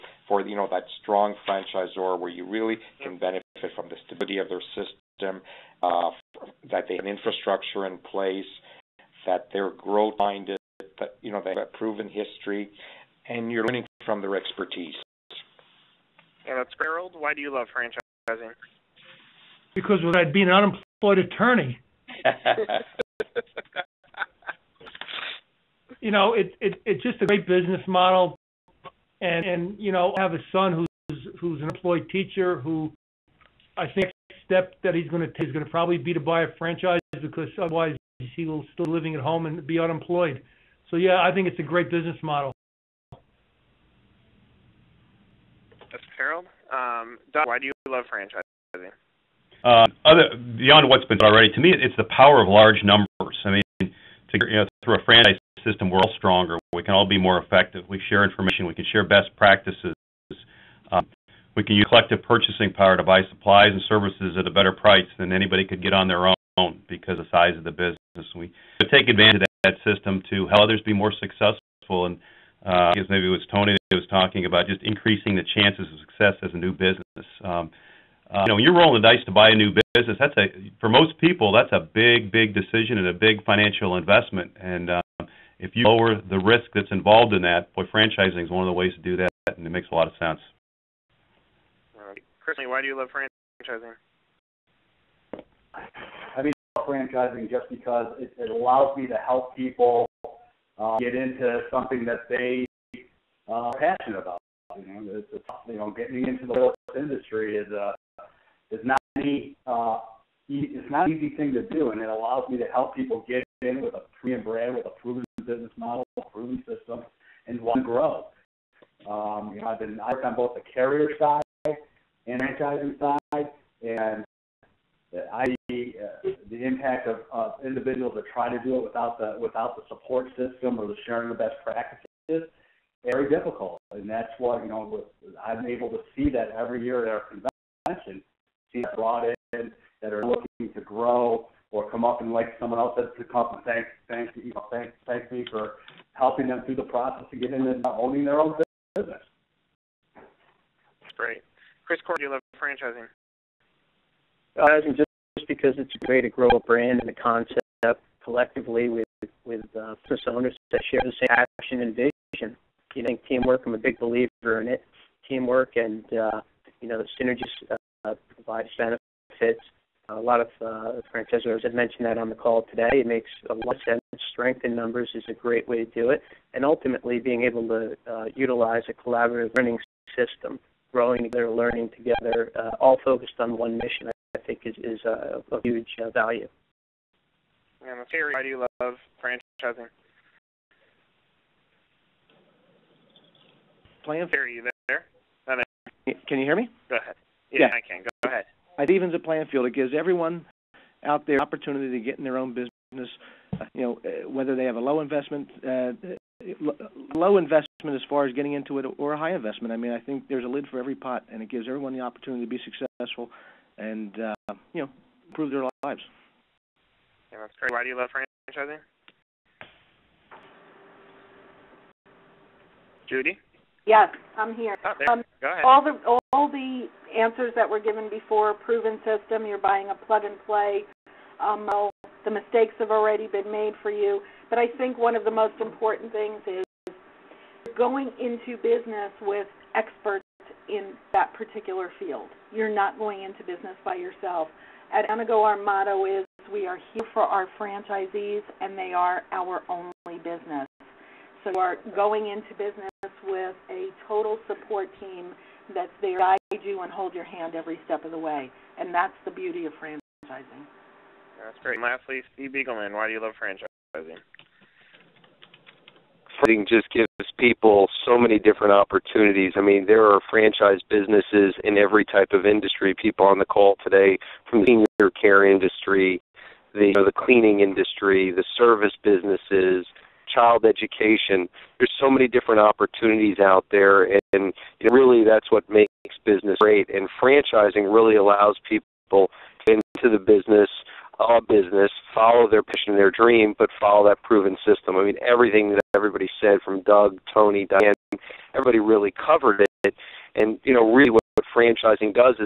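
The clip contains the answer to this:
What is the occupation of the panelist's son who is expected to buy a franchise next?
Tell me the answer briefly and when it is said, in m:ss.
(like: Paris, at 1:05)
Teacher, at 0:32.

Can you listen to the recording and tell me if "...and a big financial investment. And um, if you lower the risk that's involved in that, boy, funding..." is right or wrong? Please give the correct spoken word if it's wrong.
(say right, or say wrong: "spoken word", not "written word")
wrong: "franchising", not "funding".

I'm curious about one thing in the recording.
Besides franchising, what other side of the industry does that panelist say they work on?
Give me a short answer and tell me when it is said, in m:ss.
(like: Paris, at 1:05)
Carrier side, at 2:00.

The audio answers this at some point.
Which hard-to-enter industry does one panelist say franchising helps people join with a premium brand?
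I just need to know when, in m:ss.
1:46.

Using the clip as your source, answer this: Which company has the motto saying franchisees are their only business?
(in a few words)
Anago.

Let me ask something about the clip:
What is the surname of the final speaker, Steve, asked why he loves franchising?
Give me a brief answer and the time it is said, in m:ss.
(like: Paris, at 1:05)
Beagelman, at 4:22.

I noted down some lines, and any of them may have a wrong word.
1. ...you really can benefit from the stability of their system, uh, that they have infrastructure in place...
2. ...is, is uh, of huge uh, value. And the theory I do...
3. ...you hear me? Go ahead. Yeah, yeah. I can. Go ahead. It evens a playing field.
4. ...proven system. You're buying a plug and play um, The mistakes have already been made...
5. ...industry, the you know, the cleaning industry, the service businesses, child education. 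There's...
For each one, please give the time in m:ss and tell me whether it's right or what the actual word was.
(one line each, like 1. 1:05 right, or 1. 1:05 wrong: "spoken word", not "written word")
1. 0:02 right
2. 3:04 right
3. 3:16 right
4. 3:48 right
5. 4:35 right.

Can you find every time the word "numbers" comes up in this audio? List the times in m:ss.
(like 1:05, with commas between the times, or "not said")
0:52, 2:54.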